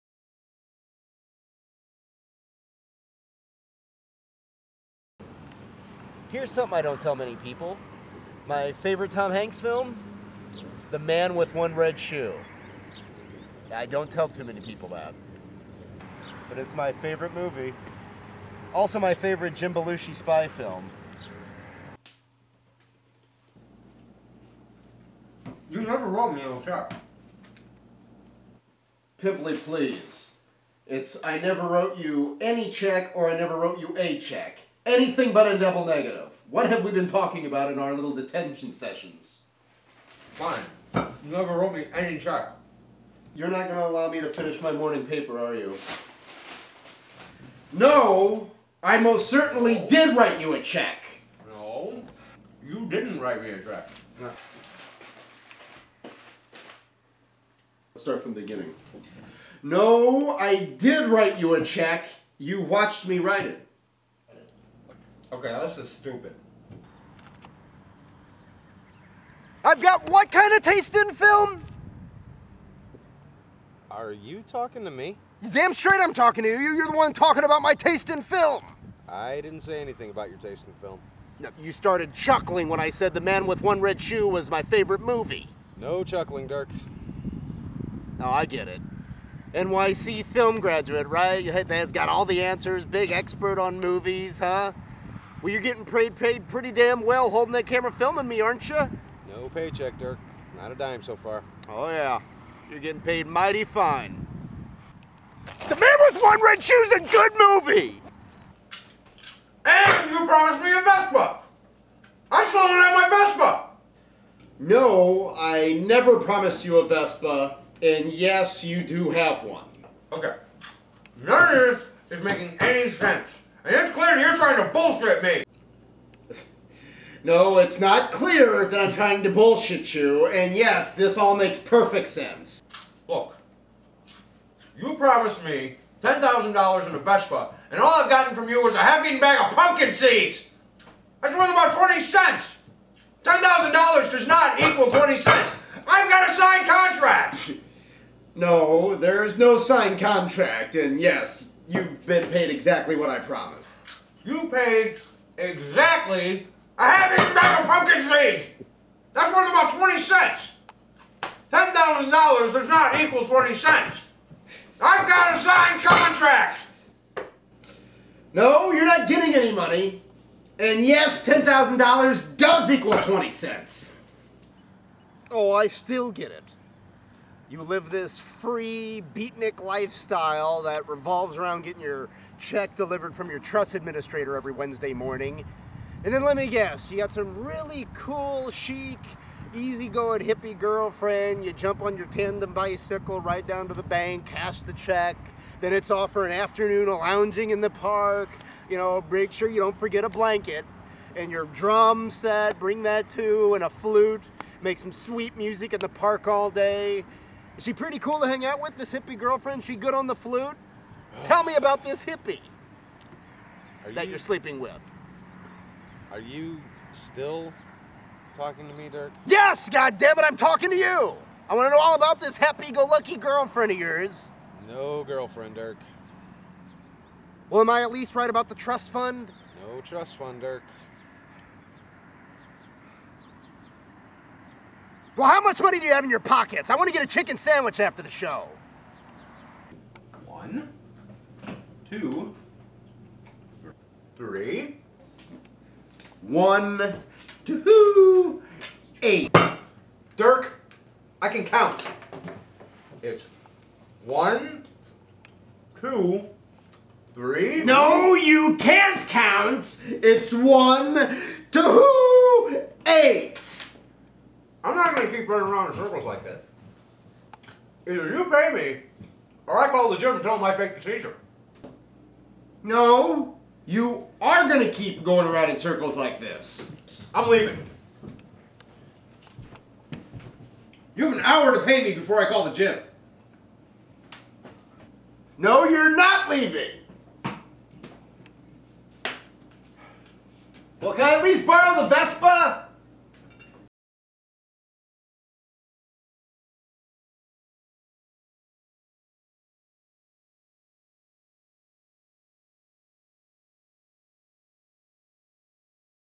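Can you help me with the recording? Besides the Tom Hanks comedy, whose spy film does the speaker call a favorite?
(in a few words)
Jim Belushi.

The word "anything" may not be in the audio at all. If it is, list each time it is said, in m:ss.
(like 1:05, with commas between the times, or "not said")
0:34, 1:19.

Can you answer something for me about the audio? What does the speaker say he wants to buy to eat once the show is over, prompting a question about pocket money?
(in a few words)
chicken sandwich.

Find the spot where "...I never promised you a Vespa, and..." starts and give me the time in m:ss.
1:55.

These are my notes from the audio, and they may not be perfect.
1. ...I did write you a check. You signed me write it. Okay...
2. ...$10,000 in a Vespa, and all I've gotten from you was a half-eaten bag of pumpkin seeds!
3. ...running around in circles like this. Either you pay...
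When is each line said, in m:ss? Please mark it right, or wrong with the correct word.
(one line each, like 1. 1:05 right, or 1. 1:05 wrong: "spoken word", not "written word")
1. 1:00 wrong: "watched", not "signed"
2. 2:16 right
3. 4:25 right.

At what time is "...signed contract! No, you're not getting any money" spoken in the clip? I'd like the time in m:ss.
2:45.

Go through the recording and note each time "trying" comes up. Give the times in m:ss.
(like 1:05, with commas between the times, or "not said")
2:04, 2:08.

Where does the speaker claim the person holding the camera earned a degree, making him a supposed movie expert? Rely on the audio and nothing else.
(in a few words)
NYC film.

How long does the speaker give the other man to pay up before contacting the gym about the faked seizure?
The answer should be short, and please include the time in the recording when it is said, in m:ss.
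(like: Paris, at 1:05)
1 hour, at 4:41.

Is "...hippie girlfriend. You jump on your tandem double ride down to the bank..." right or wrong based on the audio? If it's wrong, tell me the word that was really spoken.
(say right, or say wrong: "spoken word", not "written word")
wrong: "bicycle", not "double".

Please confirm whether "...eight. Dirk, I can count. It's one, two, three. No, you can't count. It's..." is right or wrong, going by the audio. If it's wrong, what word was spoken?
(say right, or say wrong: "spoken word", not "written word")
right.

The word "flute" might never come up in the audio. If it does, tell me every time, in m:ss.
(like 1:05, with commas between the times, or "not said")
3:23, 3:30.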